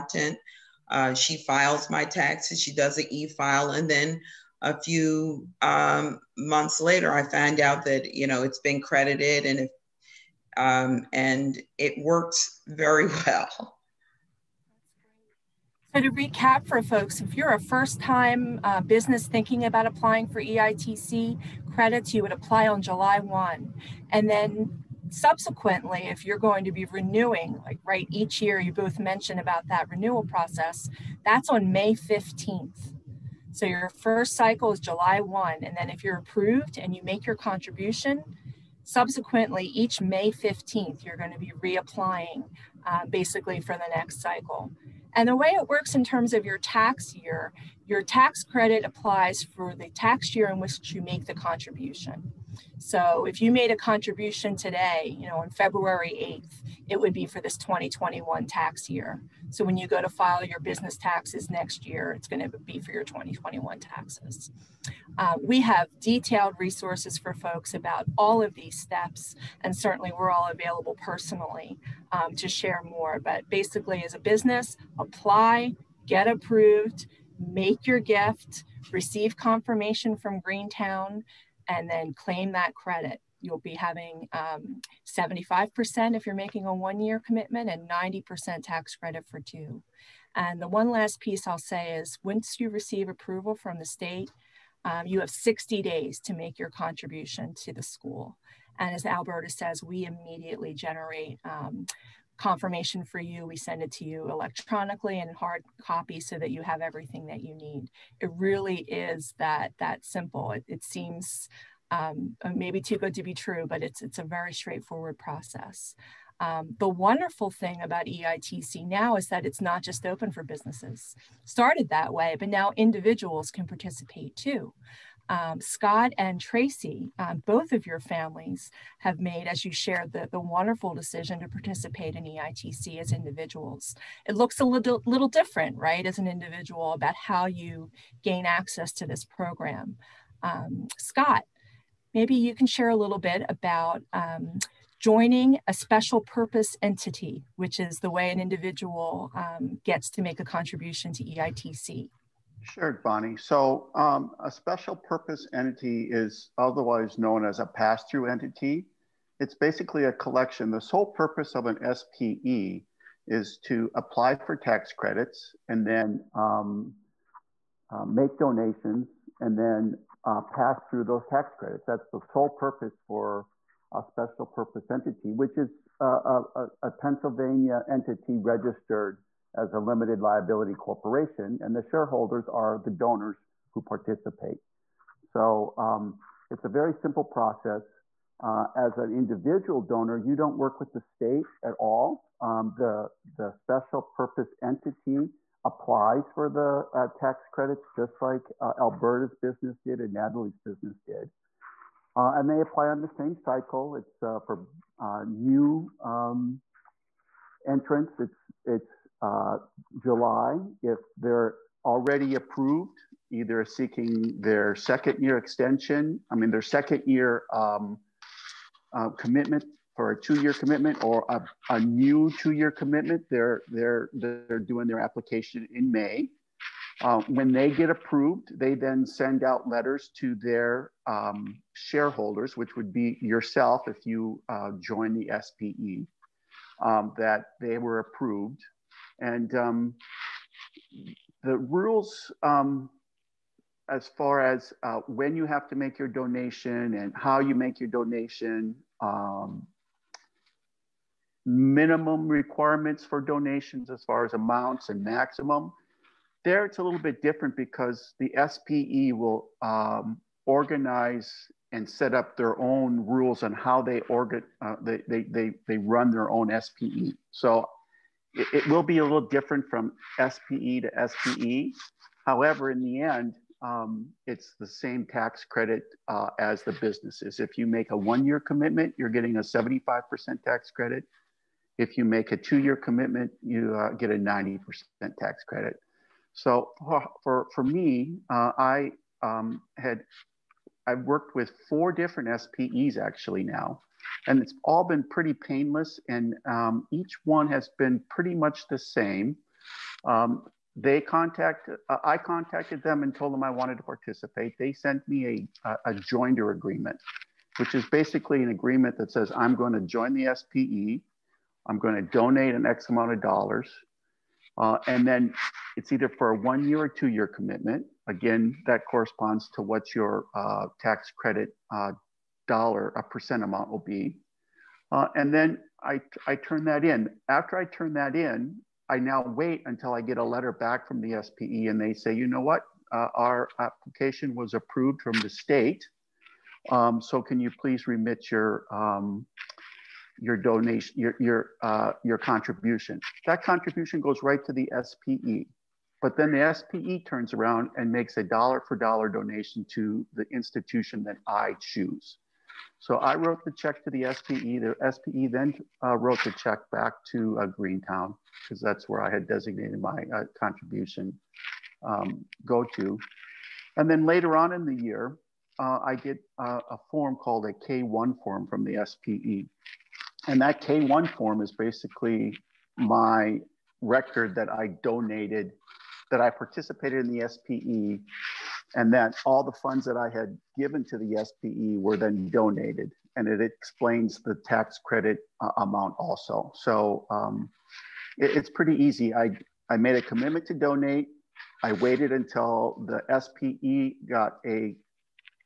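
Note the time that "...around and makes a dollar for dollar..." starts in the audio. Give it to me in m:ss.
5:47.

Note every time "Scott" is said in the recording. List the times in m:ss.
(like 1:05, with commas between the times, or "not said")
2:05, 2:20.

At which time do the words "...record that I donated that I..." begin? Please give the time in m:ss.
6:13.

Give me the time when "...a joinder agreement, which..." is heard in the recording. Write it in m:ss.
5:05.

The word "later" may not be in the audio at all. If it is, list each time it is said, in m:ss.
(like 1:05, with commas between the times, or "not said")
0:06, 6:04.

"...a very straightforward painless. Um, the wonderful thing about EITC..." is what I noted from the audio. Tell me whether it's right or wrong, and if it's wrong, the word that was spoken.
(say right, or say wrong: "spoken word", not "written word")
wrong: "process", not "painless".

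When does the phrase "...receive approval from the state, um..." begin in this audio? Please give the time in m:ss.
1:32.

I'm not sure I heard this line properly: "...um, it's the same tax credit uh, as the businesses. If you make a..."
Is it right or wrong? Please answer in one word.
right.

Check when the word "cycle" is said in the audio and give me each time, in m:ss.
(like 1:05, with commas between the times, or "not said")
0:34, 0:44, 3:23.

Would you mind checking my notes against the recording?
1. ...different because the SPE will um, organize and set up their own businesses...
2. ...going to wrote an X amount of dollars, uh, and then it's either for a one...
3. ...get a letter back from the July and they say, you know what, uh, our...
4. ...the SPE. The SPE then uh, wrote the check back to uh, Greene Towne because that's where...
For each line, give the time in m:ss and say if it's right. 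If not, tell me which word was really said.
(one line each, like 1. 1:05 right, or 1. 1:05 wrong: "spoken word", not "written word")
1. 4:17 wrong: "rules", not "businesses"
2. 5:11 wrong: "donate", not "wrote"
3. 5:30 wrong: "SPE", not "July"
4. 5:53 right.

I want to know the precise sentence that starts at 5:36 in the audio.
Um, so can you please remit your, um, your donation, your, your, uh, your contribution.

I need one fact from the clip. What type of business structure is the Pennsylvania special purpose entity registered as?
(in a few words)
limited liability corporation.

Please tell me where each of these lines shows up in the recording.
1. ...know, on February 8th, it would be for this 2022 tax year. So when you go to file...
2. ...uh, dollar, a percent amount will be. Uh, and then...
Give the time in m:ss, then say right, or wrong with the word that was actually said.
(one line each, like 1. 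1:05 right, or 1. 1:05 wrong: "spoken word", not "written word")
1. 0:55 wrong: "2021", not "2022"
2. 5:21 right.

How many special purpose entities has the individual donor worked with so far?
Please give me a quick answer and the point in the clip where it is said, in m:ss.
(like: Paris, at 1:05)
4, at 4:51.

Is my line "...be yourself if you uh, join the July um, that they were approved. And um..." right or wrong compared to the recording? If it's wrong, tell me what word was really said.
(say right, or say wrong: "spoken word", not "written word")
wrong: "SPE", not "July".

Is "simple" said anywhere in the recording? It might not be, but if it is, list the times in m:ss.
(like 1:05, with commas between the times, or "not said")
1:50, 3:06.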